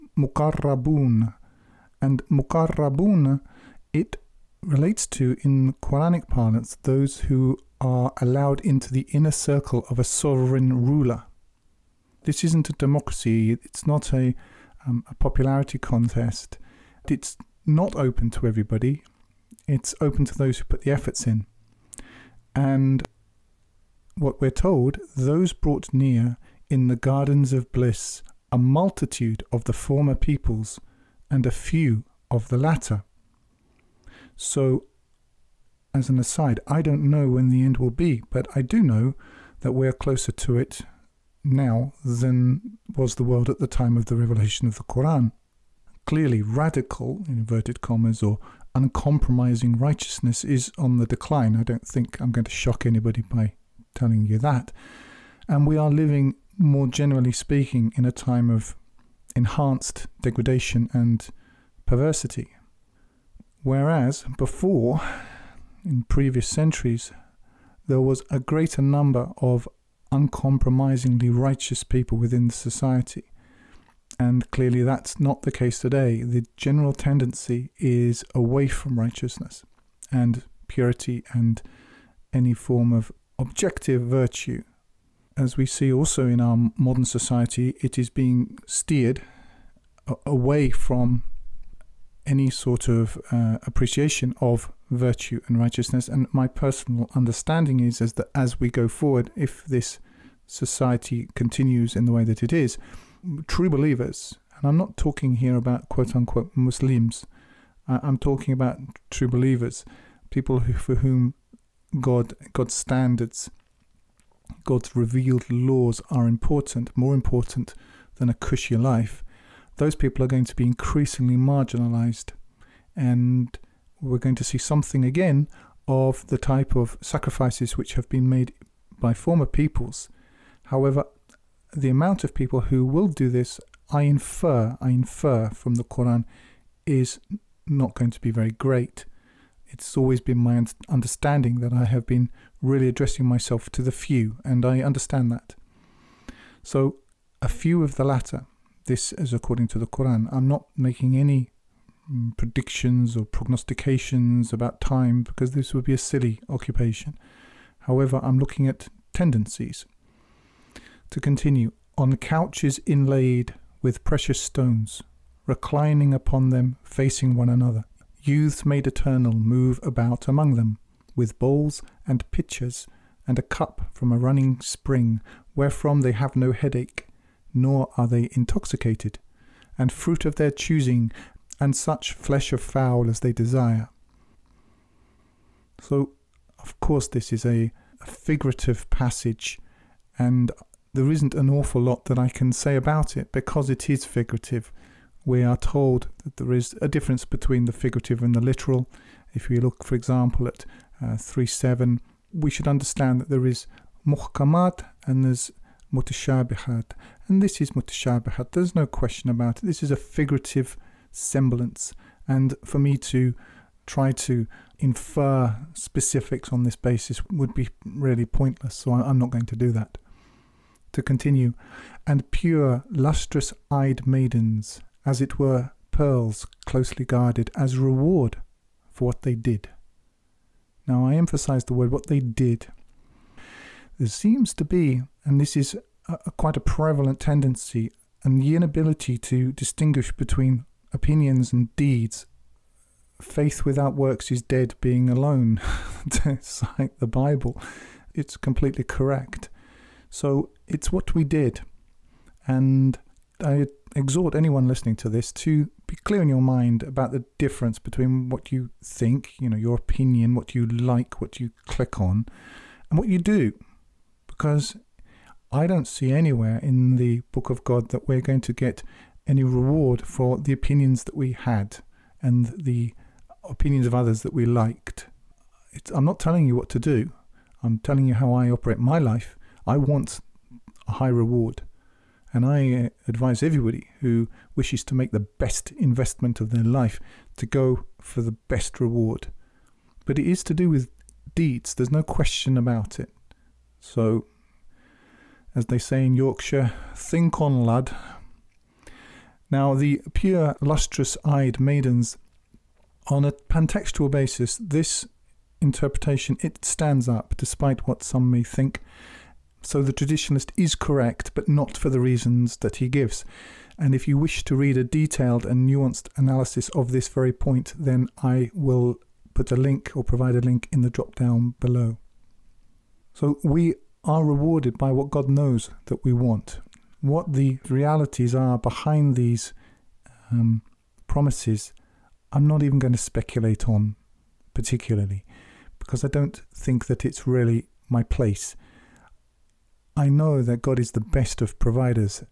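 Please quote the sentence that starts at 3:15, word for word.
We are told that there is a difference between the figurative and the literal.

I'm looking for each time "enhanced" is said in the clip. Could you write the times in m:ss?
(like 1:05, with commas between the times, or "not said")
0:59.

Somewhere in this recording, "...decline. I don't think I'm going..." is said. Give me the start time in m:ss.
0:51.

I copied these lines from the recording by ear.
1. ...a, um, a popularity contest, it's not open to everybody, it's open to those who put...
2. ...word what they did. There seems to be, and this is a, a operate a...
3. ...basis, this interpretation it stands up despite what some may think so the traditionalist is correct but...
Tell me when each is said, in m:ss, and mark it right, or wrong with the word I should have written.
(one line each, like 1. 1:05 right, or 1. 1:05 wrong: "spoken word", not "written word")
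1. 0:14 right
2. 3:51 wrong: "quite", not "operate"
3. 5:04 right.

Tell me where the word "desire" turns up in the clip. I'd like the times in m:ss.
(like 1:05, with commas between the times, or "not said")
3:03.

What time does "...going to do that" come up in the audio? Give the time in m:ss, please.
3:39.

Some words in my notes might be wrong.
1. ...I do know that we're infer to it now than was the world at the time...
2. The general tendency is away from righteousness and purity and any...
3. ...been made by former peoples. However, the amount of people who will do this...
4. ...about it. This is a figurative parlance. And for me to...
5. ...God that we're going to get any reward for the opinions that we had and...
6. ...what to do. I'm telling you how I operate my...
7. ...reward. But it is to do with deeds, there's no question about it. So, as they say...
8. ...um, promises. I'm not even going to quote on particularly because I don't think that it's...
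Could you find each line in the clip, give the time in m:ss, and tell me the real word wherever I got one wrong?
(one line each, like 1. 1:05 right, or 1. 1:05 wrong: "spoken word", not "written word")
1. 0:38 wrong: "closer", not "infer"
2. 1:16 right
3. 2:08 right
4. 3:29 wrong: "semblance", not "parlance"
5. 4:27 right
6. 4:36 right
7. 4:48 right
8. 5:30 wrong: "speculate", not "quote".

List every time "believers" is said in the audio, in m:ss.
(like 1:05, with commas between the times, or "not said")
1:43, 1:49.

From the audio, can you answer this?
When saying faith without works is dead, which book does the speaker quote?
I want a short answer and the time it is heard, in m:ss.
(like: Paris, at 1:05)
the Bible, at 4:06.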